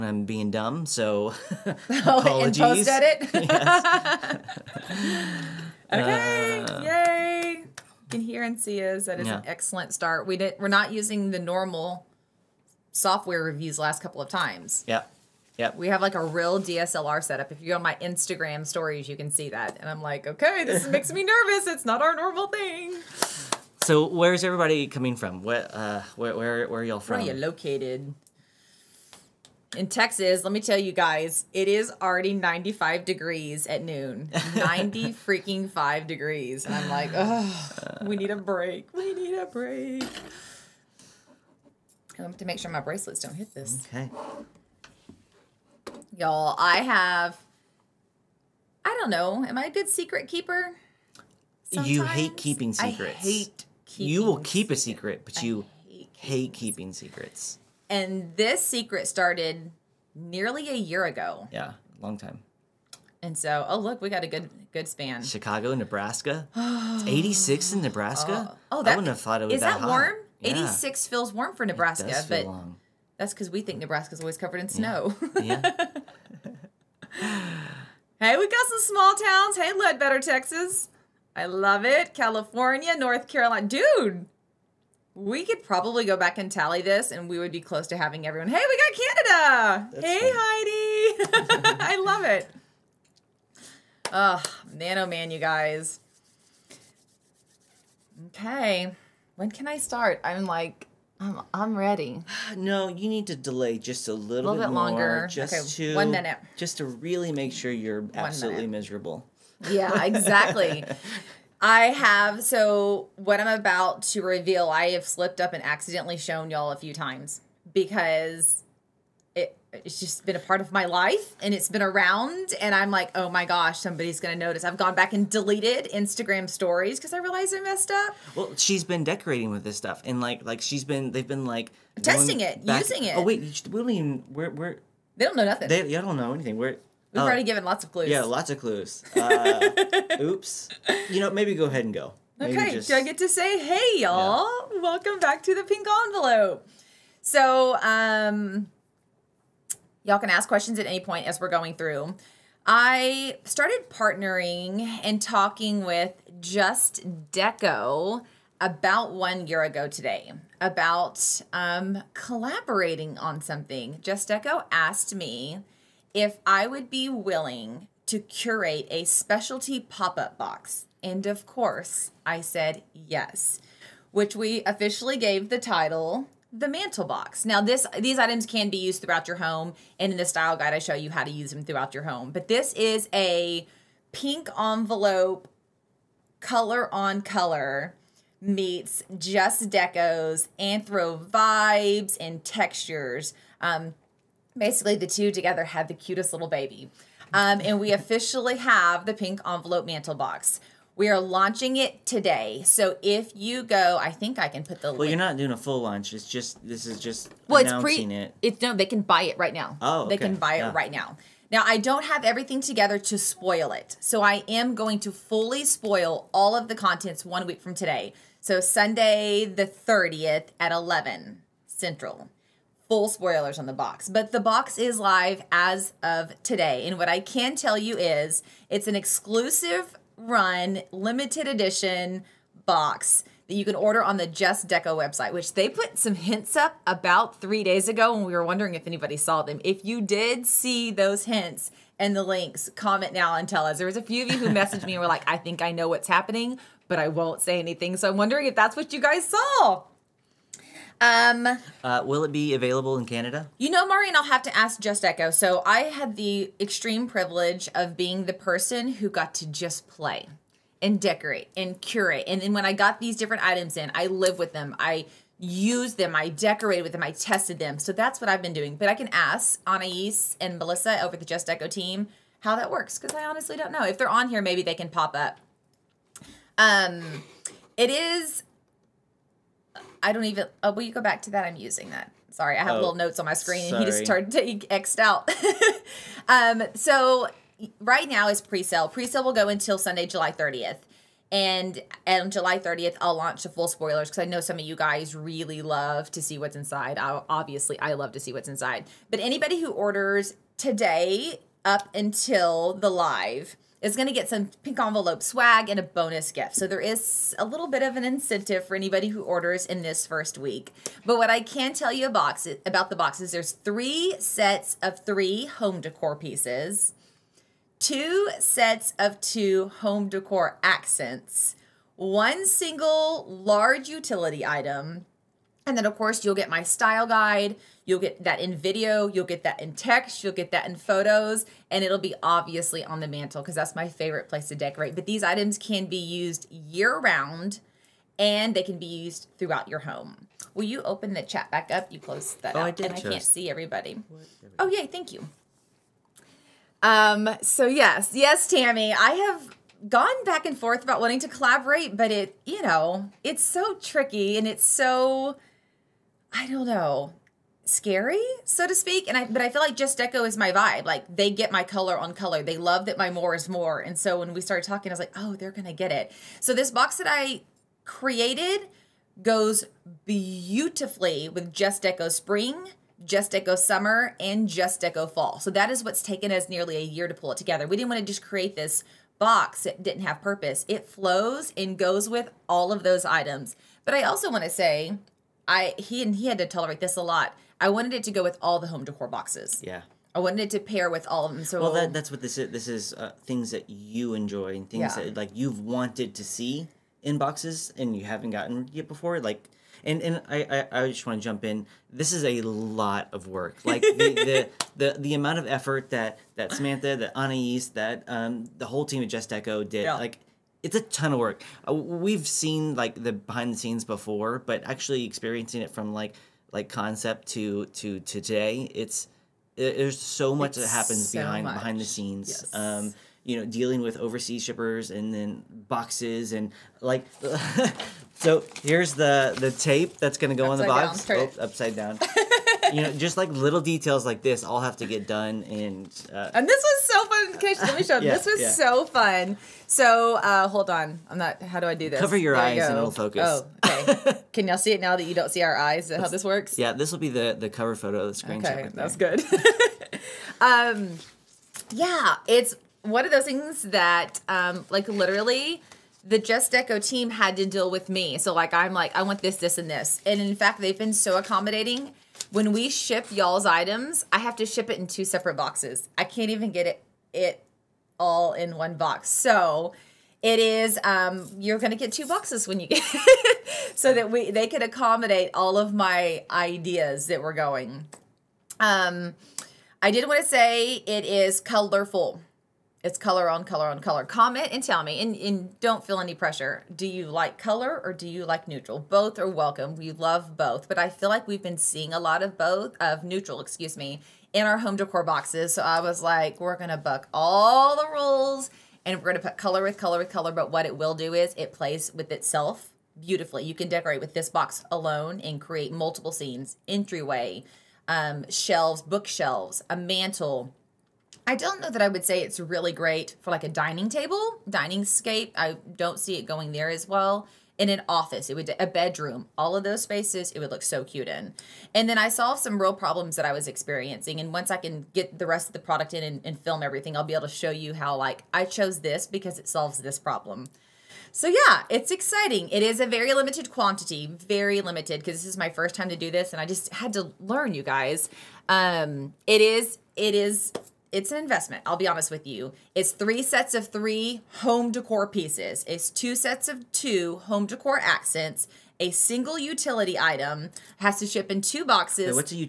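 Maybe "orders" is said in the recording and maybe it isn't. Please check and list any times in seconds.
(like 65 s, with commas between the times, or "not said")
233 s, 299 s, 309 s.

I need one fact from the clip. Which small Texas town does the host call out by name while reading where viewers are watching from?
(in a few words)
Ledbetter.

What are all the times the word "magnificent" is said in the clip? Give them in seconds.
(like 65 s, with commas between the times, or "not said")
not said.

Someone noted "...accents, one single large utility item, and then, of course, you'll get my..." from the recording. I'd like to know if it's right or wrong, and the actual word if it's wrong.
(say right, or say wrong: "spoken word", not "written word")
right.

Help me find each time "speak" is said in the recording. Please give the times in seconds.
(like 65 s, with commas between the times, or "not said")
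358 s.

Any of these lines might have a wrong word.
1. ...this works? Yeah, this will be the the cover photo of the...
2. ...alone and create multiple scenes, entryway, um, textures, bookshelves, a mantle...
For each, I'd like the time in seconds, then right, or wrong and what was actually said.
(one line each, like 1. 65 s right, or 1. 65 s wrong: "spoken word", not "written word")
1. 446 s right
2. 504 s wrong: "shelves", not "textures".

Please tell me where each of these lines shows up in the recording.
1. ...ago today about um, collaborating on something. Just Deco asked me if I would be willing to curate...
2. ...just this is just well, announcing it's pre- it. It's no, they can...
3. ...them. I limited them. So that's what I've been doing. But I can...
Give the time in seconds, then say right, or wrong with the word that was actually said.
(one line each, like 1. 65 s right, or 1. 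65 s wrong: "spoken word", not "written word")
1. 159 s right
2. 206 s right
3. 266 s wrong: "tested", not "limited".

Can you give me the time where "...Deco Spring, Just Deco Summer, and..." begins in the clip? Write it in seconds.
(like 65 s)
371 s.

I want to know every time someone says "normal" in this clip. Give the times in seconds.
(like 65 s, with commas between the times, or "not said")
11 s, 22 s.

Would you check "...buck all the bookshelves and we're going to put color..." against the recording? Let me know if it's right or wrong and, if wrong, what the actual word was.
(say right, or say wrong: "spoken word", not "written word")
wrong: "rules", not "bookshelves".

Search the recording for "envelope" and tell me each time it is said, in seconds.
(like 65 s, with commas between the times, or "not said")
146 s, 184 s, 199 s, 304 s.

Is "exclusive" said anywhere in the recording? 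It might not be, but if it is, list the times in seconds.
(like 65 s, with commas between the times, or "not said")
228 s.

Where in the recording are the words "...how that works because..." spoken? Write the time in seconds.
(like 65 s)
272 s.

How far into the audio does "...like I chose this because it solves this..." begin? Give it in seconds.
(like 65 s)
527 s.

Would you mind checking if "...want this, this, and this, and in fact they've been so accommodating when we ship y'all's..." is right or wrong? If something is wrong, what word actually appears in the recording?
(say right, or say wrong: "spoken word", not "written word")
right.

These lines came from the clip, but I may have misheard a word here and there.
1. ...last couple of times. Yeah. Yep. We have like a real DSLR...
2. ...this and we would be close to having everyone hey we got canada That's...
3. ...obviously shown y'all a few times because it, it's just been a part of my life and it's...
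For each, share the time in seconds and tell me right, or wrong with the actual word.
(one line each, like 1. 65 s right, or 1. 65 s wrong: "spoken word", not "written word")
1. 13 s right
2. 86 s right
3. 115 s wrong: "accidentally", not "obviously".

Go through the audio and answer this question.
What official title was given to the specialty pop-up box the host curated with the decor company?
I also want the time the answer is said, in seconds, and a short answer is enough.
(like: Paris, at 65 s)
The mantel box, at 176 s.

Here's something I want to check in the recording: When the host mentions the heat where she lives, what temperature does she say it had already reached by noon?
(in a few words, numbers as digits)
95 degrees.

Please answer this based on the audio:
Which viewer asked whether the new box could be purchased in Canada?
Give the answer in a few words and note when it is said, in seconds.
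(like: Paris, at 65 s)
Maureen, at 253 s.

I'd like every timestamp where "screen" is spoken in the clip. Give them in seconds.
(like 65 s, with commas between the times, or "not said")
283 s, 448 s.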